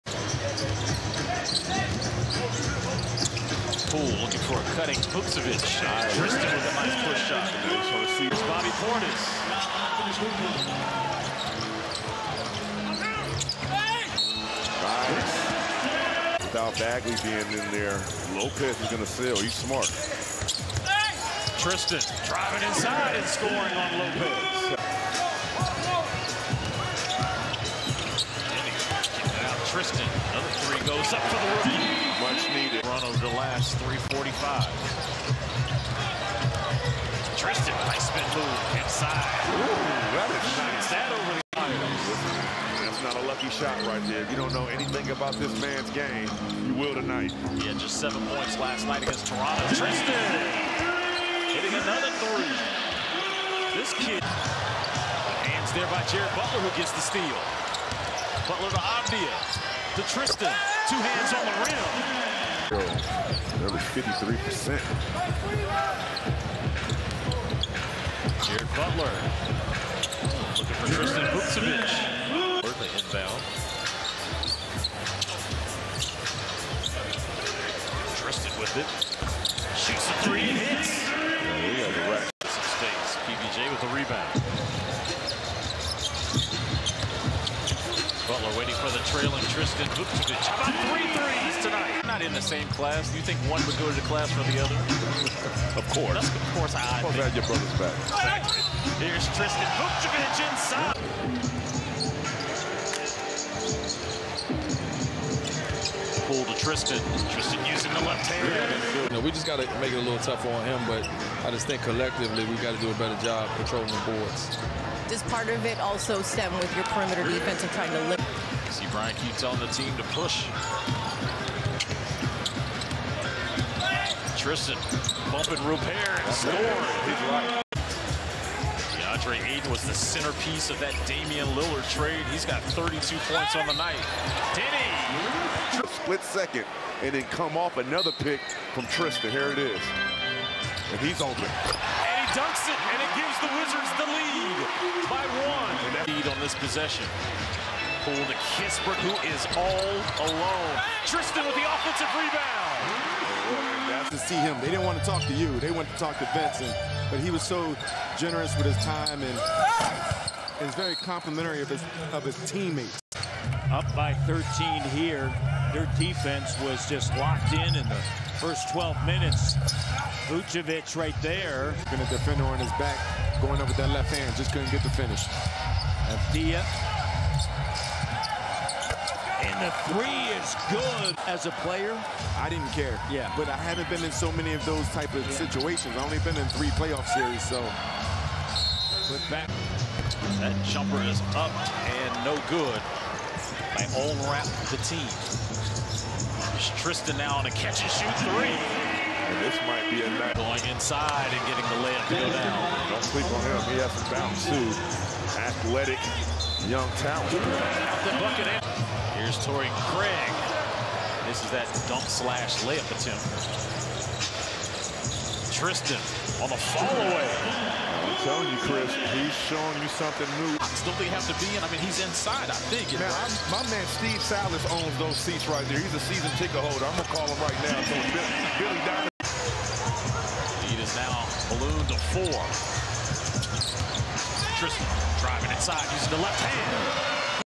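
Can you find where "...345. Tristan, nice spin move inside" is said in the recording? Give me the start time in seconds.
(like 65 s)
34 s.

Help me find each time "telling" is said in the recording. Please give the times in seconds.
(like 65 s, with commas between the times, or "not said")
119 s, 218 s.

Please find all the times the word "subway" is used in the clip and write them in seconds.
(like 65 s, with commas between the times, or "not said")
not said.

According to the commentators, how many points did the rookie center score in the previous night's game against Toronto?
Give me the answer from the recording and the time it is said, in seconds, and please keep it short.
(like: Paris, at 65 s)
7, at 47 s.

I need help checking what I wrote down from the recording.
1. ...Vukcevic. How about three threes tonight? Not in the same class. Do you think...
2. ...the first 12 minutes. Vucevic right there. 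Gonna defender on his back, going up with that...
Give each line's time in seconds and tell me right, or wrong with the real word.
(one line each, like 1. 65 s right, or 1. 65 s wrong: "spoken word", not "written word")
1. 89 s right
2. 167 s right.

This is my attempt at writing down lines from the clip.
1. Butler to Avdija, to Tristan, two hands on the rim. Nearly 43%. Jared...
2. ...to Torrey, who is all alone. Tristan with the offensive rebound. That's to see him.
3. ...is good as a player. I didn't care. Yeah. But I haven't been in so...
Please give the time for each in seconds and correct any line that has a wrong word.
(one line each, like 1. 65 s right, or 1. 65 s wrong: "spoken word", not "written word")
1. 58 s wrong: "53", not "43"
2. 148 s wrong: "Kispert", not "Torrey"
3. 180 s right.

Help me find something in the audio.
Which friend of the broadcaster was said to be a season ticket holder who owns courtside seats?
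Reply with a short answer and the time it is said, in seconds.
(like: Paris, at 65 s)
Steve Salas, at 224 s.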